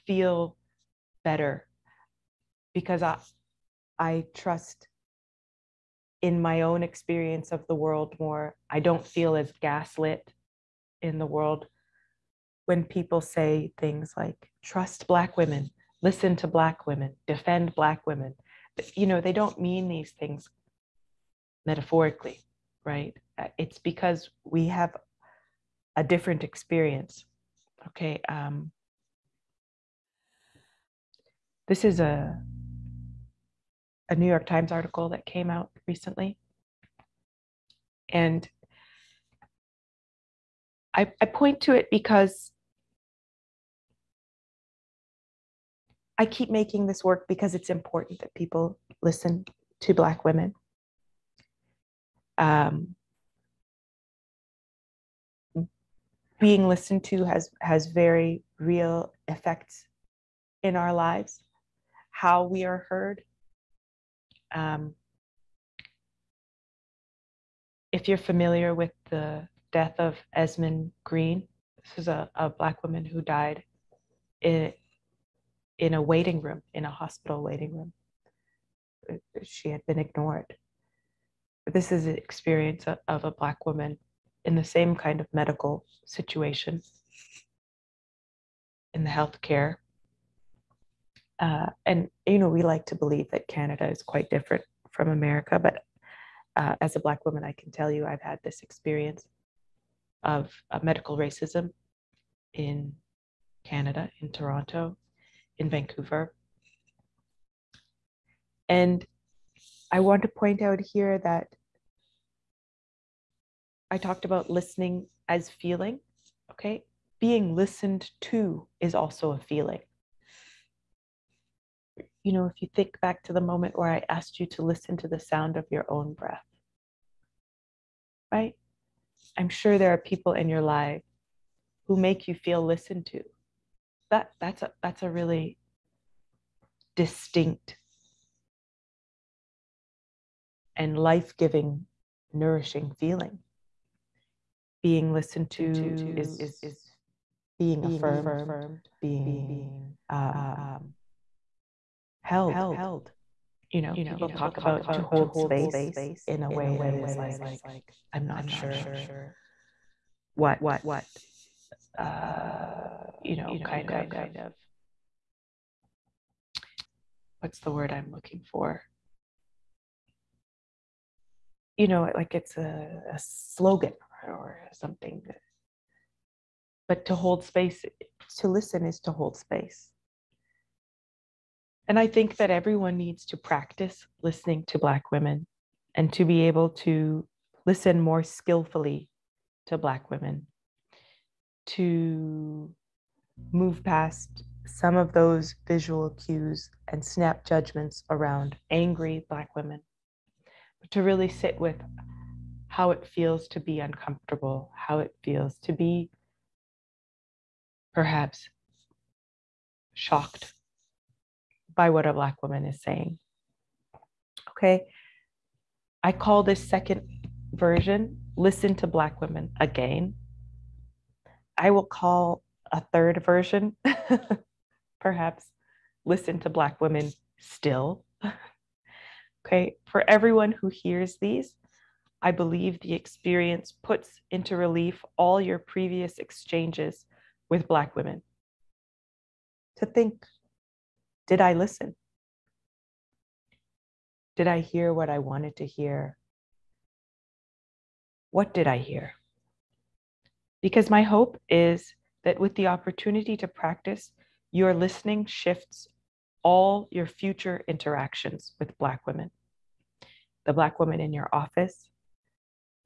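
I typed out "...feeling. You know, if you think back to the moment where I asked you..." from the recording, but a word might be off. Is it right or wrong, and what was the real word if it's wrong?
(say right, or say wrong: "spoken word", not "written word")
right.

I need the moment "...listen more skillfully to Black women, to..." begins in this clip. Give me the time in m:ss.
3:07.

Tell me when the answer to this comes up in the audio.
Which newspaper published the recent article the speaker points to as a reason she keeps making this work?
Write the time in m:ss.
0:34.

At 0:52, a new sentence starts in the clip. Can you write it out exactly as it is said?
Um, being listened to has has very real effects in our lives, how we are heard.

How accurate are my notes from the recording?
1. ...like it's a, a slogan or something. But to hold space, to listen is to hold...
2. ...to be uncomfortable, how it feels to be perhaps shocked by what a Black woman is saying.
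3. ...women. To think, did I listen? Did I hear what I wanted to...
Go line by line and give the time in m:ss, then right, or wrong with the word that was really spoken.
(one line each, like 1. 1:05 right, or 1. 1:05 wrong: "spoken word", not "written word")
1. 2:52 right
2. 3:23 right
3. 3:57 right.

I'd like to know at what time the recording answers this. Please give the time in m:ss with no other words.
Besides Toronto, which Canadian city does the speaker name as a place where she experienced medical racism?
1:45.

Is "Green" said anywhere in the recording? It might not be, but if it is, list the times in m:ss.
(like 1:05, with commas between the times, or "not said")
1:11.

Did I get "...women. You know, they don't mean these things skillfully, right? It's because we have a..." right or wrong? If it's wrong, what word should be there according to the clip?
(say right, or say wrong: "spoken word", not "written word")
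wrong: "metaphorically", not "skillfully".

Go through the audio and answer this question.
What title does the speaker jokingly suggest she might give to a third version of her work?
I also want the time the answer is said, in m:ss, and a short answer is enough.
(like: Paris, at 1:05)
Listen to Black Women Still, at 3:46.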